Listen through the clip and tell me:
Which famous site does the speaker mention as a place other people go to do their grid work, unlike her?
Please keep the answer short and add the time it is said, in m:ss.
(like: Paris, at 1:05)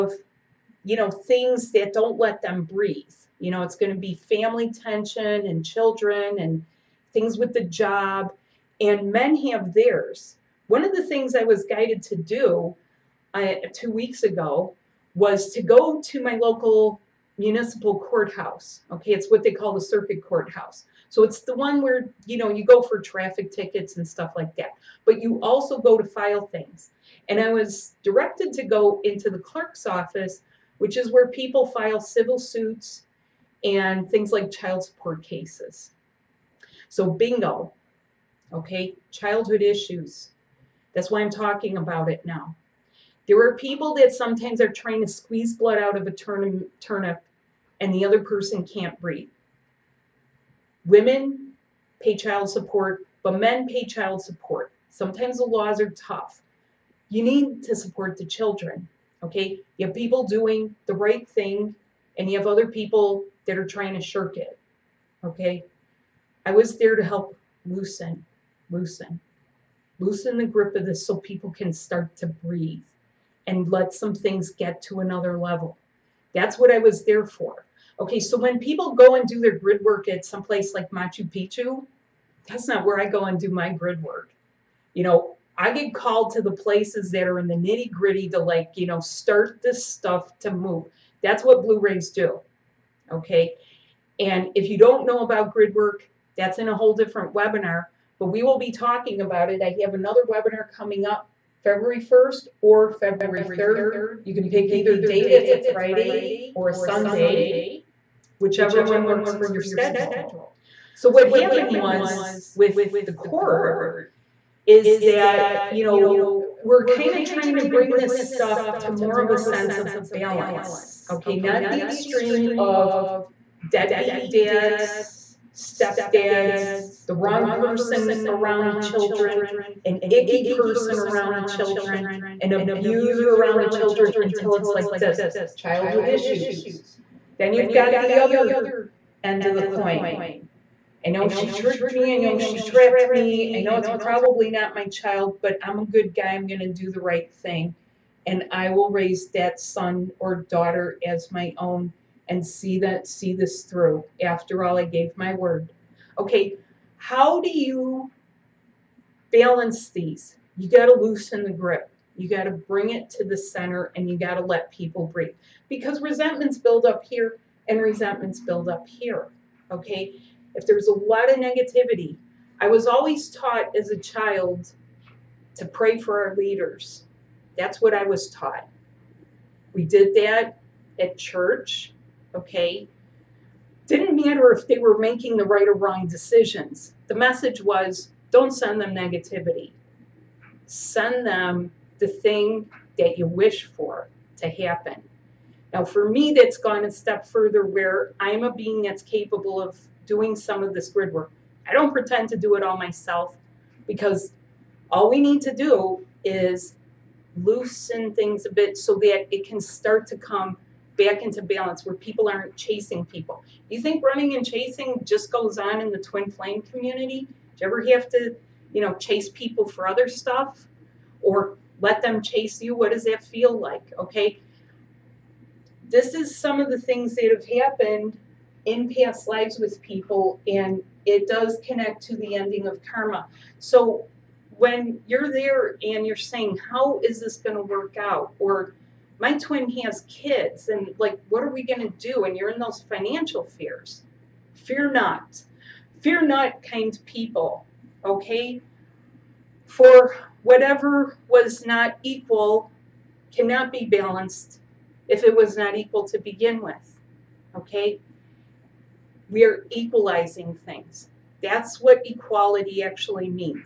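Machu Picchu, at 1:20.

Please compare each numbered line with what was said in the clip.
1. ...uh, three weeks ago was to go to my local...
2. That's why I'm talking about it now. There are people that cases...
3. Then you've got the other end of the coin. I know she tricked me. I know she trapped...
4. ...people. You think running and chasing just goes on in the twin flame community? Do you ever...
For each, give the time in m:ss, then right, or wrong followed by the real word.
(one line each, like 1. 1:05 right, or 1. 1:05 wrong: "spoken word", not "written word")
1. 0:13 wrong: "two", not "three"
2. 0:40 wrong: "sometimes", not "cases"
3. 2:17 right
4. 3:33 right.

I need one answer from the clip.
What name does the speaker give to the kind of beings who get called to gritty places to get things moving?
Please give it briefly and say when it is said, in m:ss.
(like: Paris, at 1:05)
Blue Rays, at 1:31.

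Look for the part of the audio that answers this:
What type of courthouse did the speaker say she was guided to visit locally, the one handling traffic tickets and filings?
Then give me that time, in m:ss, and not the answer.
0:19.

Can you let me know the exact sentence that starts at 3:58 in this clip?
Or my twin has kids and like, what are we going to do?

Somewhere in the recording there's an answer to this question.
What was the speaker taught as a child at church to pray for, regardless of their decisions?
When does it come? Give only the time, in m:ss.
2:56.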